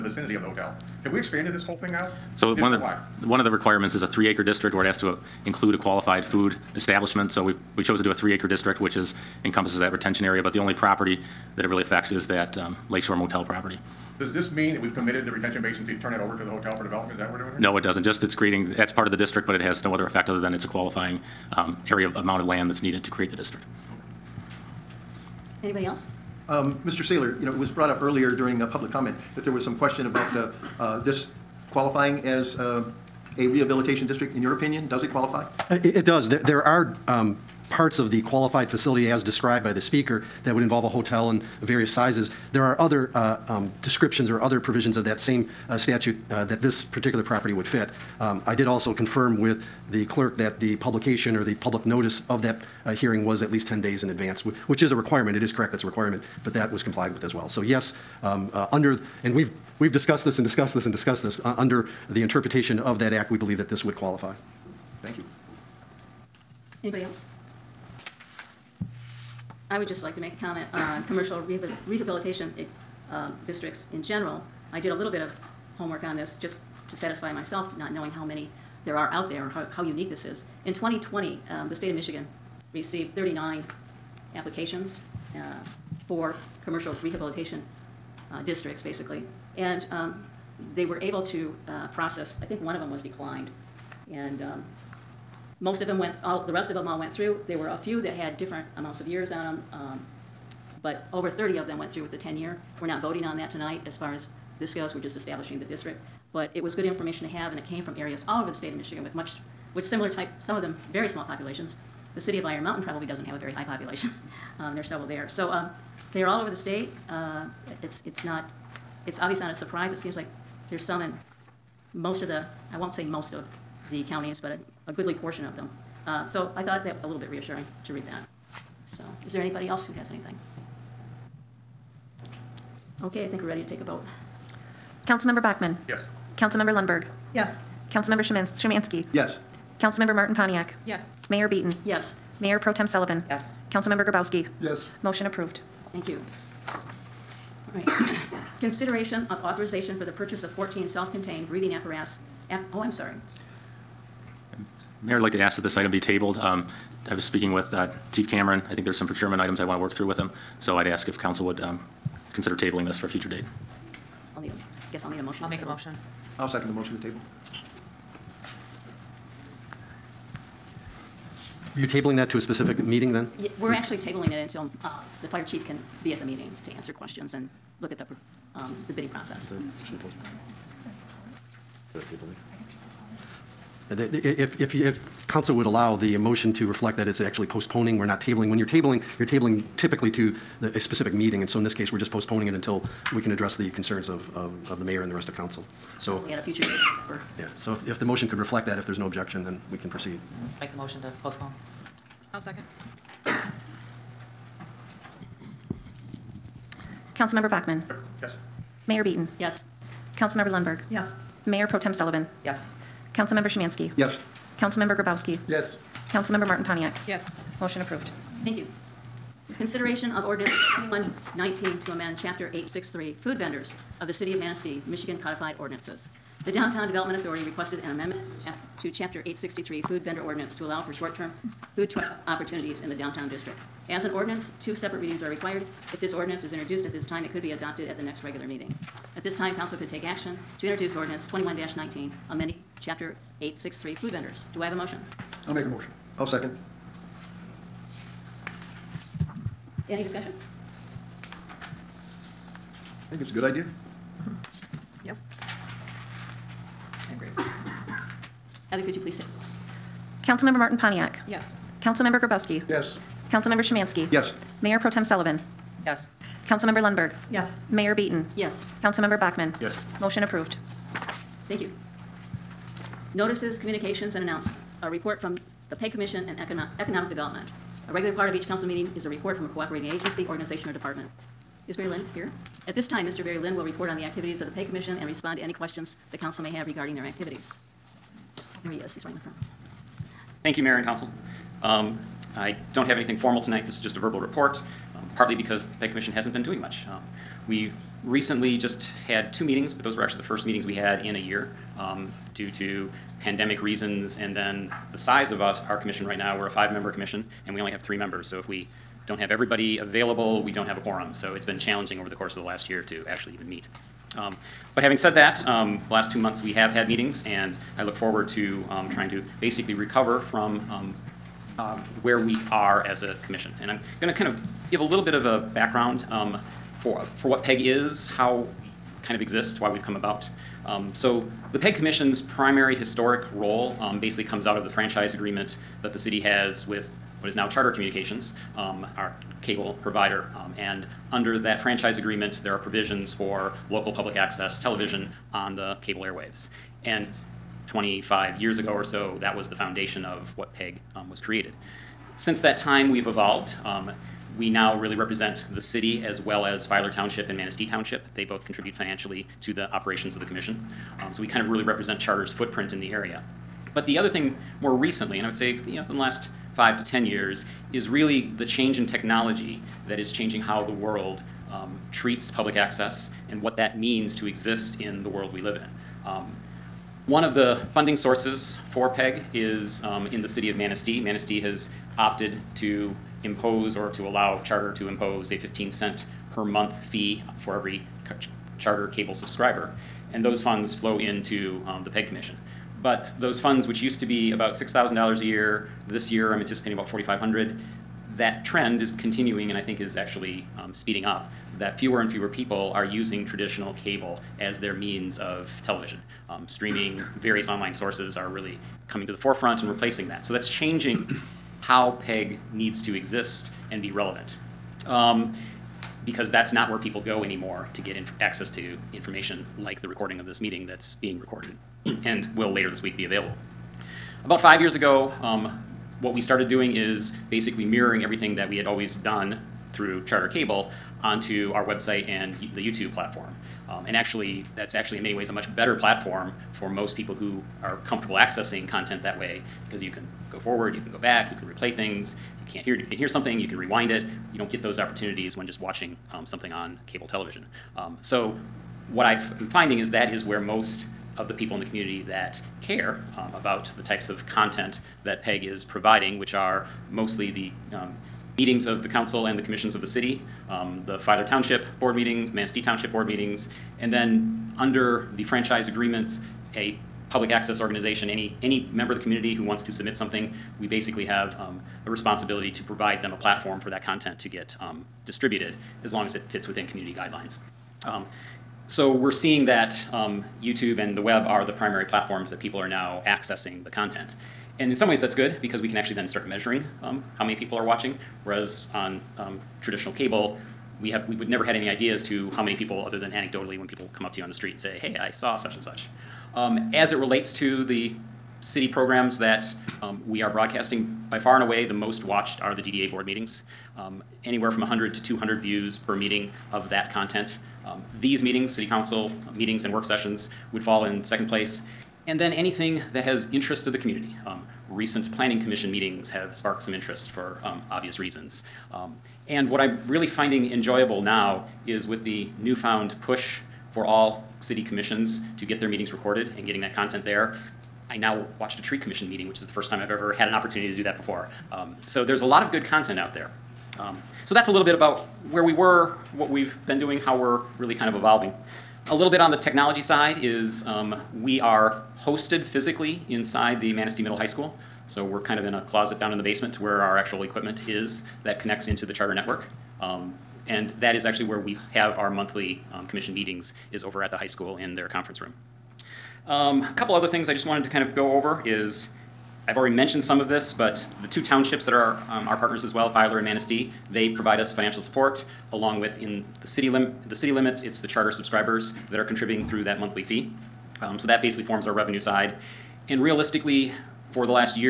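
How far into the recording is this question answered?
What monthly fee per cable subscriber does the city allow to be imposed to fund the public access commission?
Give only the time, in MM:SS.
06:25.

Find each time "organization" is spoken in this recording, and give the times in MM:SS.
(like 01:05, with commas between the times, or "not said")
04:40, 07:47.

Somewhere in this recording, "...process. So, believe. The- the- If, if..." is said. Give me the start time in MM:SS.
02:59.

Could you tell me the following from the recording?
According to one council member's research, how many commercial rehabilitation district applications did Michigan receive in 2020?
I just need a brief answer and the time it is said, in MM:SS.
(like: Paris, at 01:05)
39, at 01:23.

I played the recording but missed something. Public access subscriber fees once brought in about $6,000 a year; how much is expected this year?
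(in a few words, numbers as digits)
$4,500.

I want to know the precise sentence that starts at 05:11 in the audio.
So it's been challenging over the course of the last year to actually even meet.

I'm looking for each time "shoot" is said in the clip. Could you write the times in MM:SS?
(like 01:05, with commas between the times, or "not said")
not said.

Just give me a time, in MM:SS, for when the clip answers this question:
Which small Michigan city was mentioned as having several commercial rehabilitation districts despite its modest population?
01:52.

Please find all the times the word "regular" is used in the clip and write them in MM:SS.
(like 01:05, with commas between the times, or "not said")
03:58, 04:37.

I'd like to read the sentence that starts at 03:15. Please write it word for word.
So, a future date in December.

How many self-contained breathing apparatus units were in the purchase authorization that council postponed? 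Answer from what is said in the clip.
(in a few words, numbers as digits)
14.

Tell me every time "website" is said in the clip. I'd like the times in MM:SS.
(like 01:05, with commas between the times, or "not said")
07:11.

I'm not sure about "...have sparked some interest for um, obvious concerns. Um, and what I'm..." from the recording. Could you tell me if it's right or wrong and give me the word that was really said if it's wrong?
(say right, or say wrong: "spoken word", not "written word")
wrong: "reasons", not "concerns".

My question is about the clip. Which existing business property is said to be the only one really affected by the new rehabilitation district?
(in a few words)
Lakeshore Motel.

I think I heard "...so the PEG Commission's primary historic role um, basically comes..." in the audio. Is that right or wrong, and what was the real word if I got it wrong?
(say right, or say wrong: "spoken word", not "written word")
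right.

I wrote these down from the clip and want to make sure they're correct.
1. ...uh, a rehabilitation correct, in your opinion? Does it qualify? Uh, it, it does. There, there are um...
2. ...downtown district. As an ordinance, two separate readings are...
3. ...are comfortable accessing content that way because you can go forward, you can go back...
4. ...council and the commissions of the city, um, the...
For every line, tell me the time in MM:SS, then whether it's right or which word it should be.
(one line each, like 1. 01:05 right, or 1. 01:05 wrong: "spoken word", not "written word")
1. 00:32 wrong: "district", not "correct"
2. 03:52 right
3. 07:17 right
4. 07:38 right.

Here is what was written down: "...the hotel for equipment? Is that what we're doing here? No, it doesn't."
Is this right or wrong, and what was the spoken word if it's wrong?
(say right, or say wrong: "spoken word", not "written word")
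wrong: "development", not "equipment".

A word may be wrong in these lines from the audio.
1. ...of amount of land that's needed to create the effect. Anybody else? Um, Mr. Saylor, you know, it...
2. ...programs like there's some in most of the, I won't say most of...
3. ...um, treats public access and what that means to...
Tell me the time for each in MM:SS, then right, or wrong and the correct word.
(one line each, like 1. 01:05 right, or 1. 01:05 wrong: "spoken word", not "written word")
1. 00:22 wrong: "district", not "effect"
2. 01:59 wrong: "seems", not "programs"
3. 06:11 right.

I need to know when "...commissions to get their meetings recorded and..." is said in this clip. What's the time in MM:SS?
08:44.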